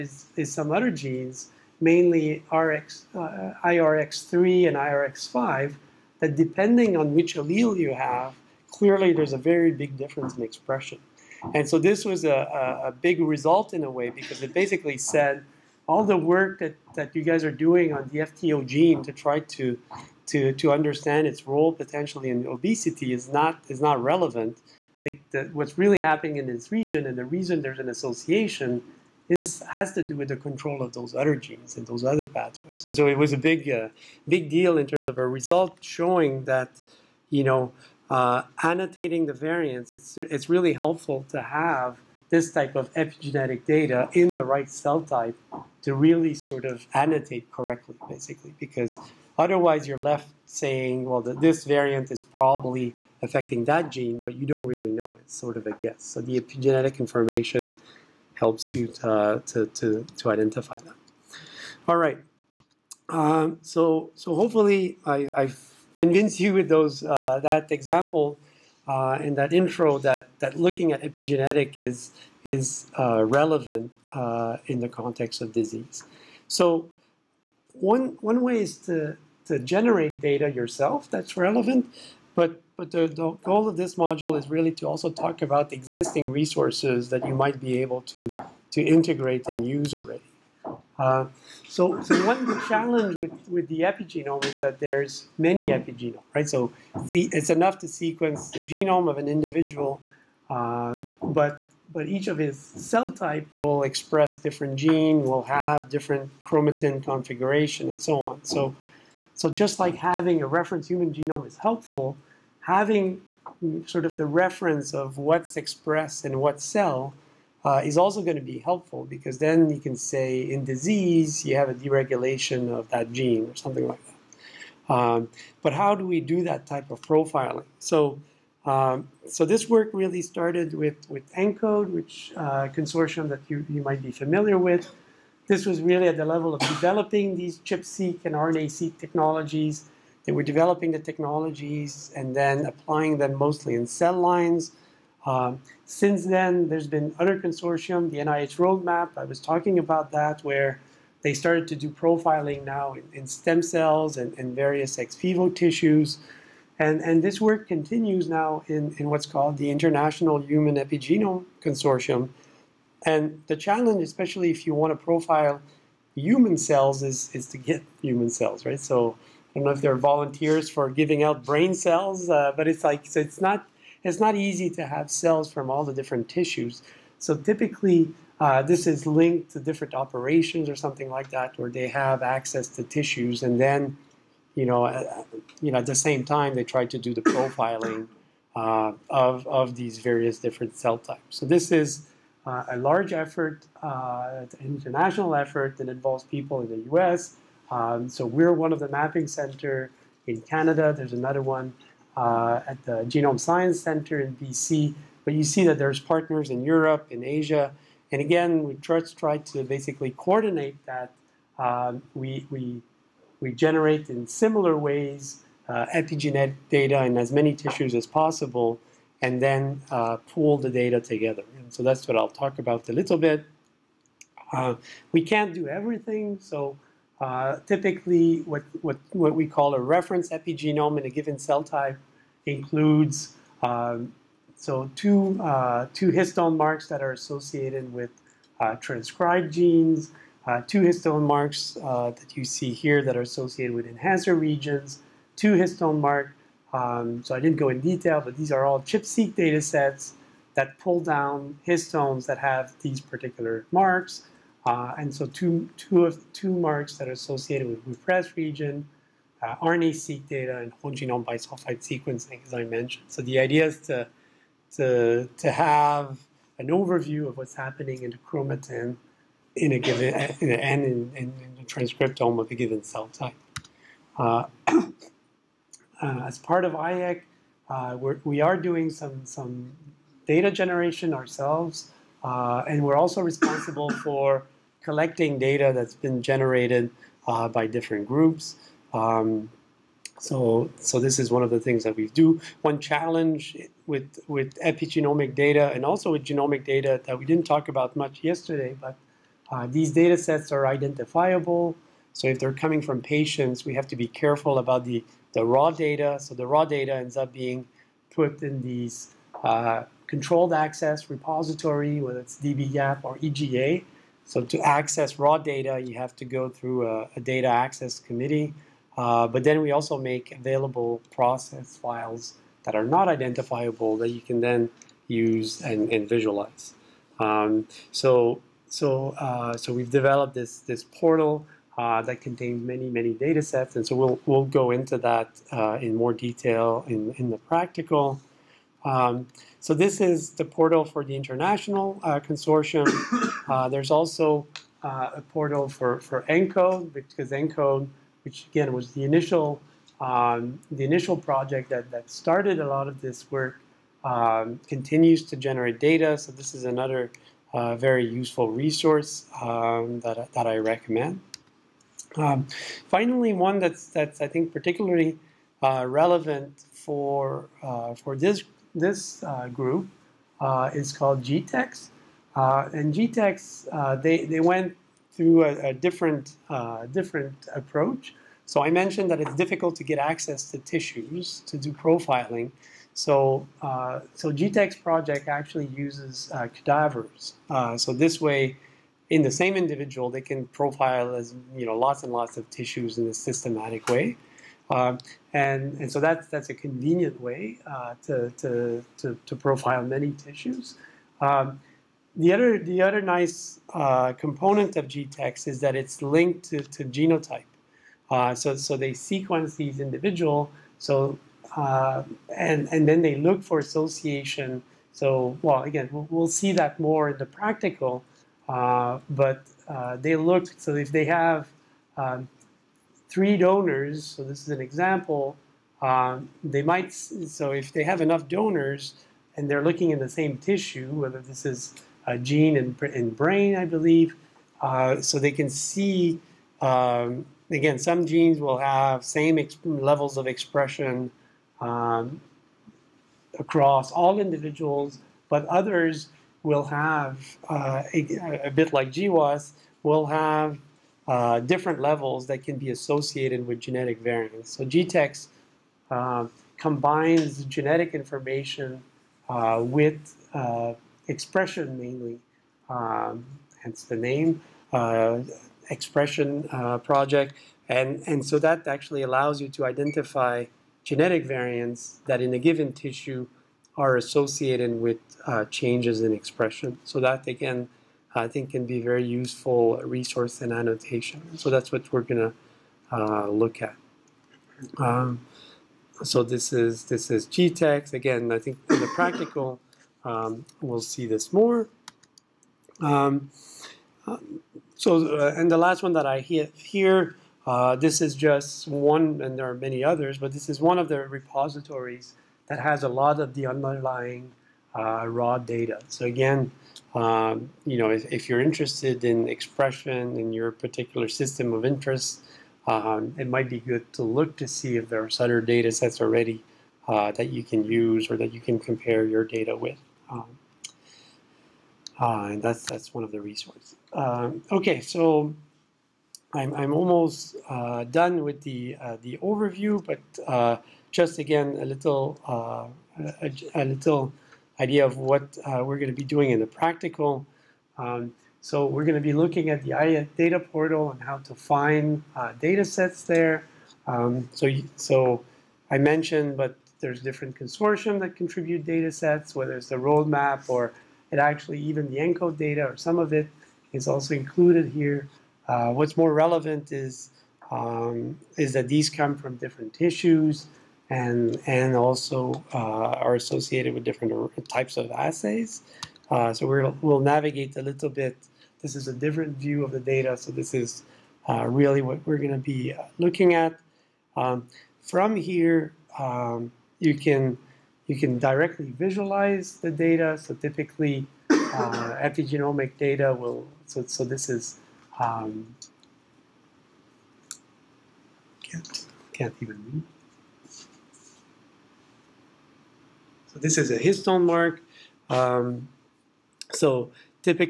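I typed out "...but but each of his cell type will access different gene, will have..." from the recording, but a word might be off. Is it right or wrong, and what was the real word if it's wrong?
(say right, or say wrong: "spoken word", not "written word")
wrong: "express", not "access".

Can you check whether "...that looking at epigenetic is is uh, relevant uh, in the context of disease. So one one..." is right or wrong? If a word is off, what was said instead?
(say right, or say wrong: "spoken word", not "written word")
right.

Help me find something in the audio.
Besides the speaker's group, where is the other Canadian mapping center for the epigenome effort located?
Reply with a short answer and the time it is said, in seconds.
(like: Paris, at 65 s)
Genome Science Center, at 203 s.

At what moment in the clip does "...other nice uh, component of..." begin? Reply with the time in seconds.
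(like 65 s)
402 s.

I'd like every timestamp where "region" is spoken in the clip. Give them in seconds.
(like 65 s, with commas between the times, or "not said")
26 s, 244 s, 258 s.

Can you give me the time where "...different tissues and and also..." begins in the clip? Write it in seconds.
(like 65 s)
559 s.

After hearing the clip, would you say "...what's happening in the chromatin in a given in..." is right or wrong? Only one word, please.
right.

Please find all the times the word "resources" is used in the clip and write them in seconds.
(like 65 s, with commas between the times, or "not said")
86 s, 358 s, 479 s, 523 s.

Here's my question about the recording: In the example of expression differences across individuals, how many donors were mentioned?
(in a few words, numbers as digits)
3.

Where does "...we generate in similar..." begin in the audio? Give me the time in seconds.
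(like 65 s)
213 s.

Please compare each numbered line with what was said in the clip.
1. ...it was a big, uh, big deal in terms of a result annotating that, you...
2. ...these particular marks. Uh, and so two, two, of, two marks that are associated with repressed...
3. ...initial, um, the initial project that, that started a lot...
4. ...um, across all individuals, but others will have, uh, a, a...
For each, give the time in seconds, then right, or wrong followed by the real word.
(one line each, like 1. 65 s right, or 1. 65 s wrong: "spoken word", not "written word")
1. 33 s wrong: "showing", not "annotating"
2. 252 s right
3. 349 s right
4. 441 s right.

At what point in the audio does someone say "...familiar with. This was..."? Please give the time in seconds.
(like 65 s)
134 s.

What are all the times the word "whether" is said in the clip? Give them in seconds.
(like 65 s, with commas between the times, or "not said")
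311 s, 430 s, 549 s.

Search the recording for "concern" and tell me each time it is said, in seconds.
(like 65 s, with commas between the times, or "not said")
not said.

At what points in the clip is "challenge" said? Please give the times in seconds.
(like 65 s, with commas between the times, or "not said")
92 s, 163 s, 292 s.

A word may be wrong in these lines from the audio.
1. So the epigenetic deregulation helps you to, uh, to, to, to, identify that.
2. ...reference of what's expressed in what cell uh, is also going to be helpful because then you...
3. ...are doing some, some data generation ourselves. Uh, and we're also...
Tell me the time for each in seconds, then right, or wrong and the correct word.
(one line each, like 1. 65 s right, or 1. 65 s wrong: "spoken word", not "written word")
1. 56 s wrong: "information", not "deregulation"
2. 114 s right
3. 278 s right.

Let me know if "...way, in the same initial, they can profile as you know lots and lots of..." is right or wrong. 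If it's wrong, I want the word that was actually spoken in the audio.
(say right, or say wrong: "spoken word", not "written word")
wrong: "individual", not "initial".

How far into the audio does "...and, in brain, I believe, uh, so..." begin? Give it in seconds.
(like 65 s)
432 s.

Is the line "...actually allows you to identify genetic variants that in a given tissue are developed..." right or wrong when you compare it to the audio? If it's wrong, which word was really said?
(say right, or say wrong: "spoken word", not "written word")
wrong: "associated", not "developed".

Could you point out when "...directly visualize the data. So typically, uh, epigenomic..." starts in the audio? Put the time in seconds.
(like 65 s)
578 s.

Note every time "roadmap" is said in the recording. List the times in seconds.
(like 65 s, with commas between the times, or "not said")
148 s, 549 s.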